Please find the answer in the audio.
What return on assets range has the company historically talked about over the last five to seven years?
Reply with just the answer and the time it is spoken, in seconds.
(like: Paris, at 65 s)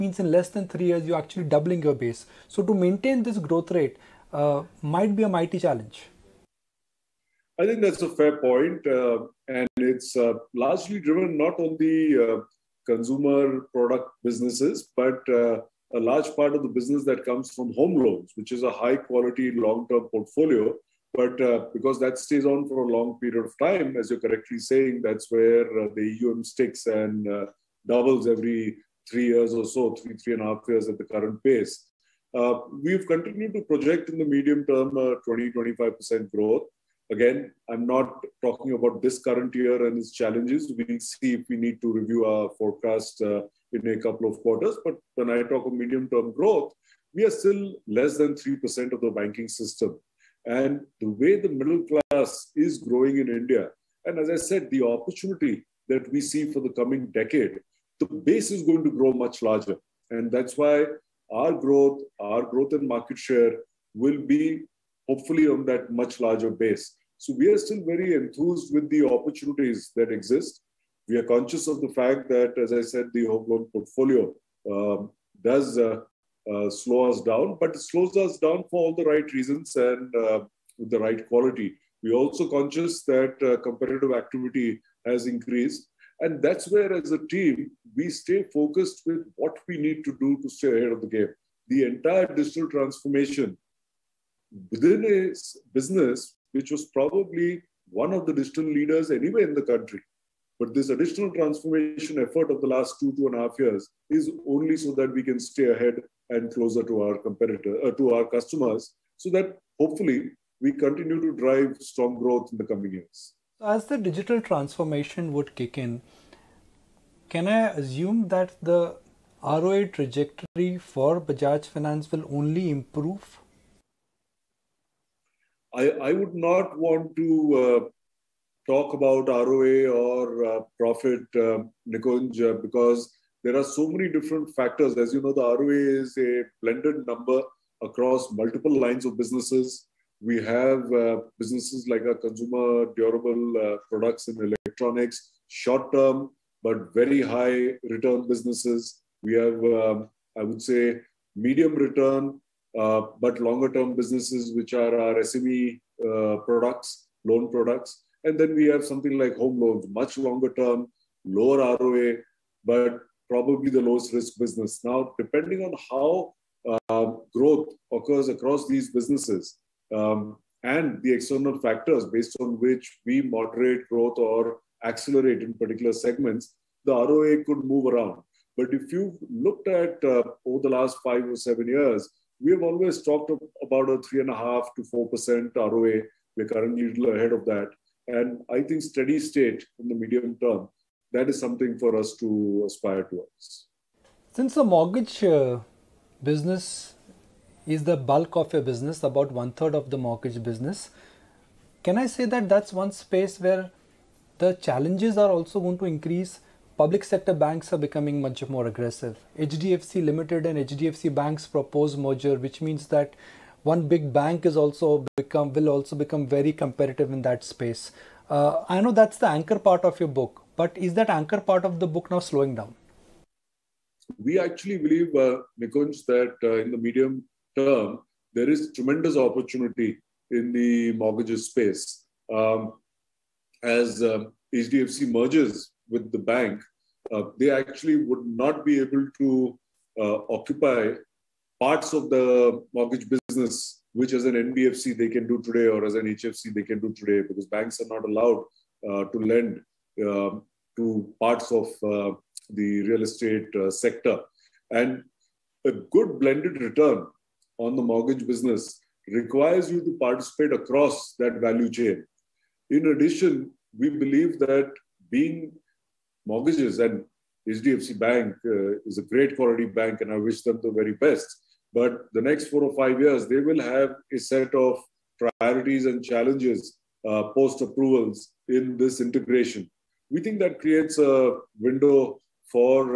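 3.5 to 4%, at 184 s.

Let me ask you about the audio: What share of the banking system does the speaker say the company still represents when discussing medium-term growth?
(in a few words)
less than 3%.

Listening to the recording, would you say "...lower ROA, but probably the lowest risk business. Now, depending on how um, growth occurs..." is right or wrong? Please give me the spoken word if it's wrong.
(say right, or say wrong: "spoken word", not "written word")
right.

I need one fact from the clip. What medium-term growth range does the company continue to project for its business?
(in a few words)
20-25%.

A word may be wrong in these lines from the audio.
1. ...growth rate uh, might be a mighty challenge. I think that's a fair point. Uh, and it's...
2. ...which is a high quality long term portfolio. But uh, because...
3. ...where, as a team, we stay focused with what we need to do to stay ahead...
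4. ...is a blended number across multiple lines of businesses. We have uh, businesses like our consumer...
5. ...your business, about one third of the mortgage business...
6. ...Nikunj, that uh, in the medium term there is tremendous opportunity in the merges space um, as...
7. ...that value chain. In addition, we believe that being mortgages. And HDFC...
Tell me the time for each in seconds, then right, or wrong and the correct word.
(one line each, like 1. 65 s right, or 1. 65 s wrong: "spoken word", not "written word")
1. 3 s right
2. 18 s right
3. 86 s right
4. 136 s right
5. 198 s right
6. 225 s wrong: "mortgages", not "merges"
7. 261 s right.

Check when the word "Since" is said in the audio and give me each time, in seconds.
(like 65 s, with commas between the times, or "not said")
194 s.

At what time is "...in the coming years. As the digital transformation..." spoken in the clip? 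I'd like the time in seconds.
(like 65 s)
112 s.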